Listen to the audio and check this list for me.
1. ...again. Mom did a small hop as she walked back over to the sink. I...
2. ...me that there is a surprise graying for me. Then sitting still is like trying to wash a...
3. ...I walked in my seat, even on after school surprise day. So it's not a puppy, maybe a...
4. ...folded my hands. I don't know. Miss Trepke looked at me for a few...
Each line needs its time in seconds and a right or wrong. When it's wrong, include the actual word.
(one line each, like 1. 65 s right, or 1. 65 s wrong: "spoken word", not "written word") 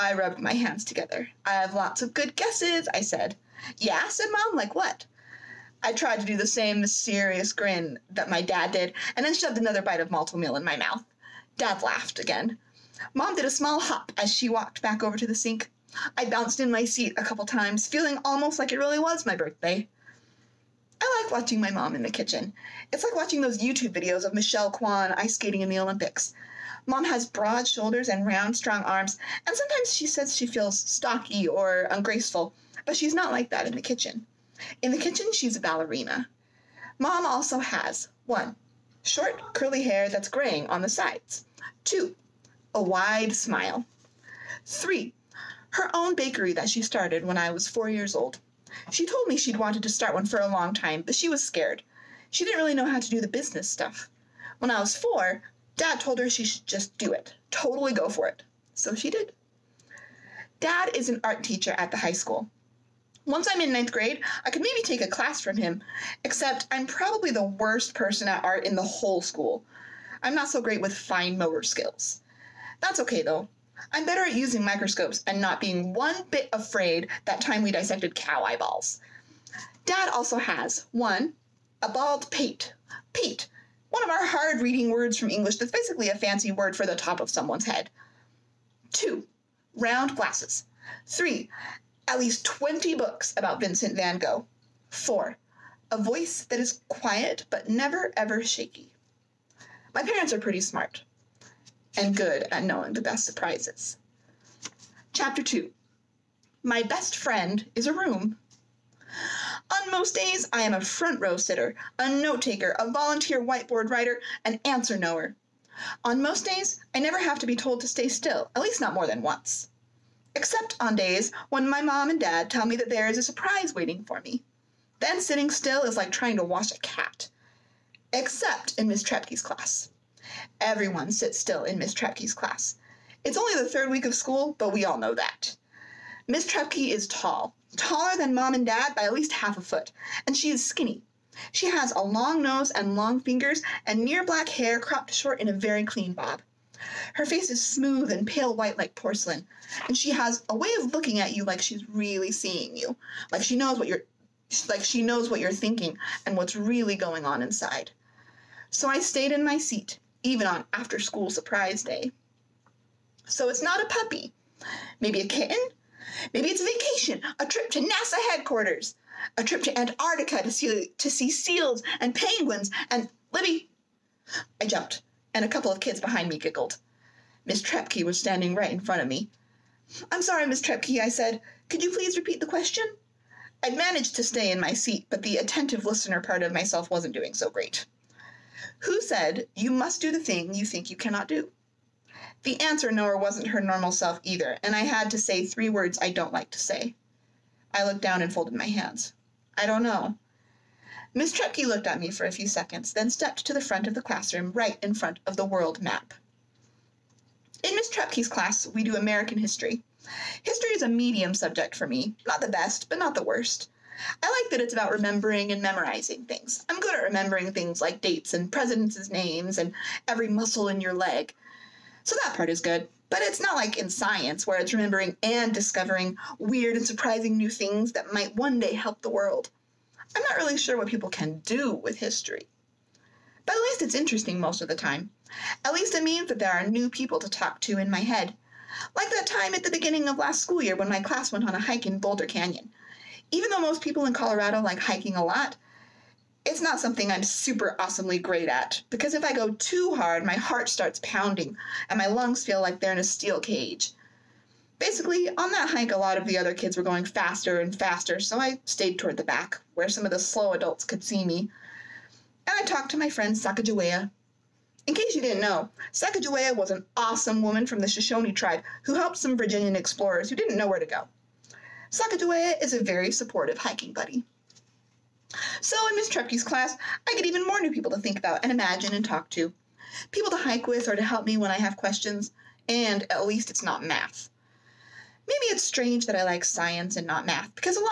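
1. 12 s right
2. 122 s wrong: "waiting", not "graying"
3. 158 s wrong: "stayed", not "walked"
4. 198 s right.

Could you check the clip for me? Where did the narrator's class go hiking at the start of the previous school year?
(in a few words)
Boulder Canyon.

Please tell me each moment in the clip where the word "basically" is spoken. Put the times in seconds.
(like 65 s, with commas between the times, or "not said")
85 s, 254 s.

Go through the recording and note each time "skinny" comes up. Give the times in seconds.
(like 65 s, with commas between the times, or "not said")
140 s.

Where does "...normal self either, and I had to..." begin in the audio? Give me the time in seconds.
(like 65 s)
193 s.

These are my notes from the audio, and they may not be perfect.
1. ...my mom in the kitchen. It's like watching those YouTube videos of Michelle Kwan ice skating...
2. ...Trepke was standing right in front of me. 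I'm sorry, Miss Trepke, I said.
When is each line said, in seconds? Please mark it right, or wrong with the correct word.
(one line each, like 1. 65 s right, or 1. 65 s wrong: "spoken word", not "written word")
1. 21 s right
2. 177 s right.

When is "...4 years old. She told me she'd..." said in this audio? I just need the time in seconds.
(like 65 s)
47 s.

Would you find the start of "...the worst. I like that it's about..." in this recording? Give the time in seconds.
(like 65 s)
213 s.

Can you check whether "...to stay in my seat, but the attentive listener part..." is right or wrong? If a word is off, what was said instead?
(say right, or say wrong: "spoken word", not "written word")
right.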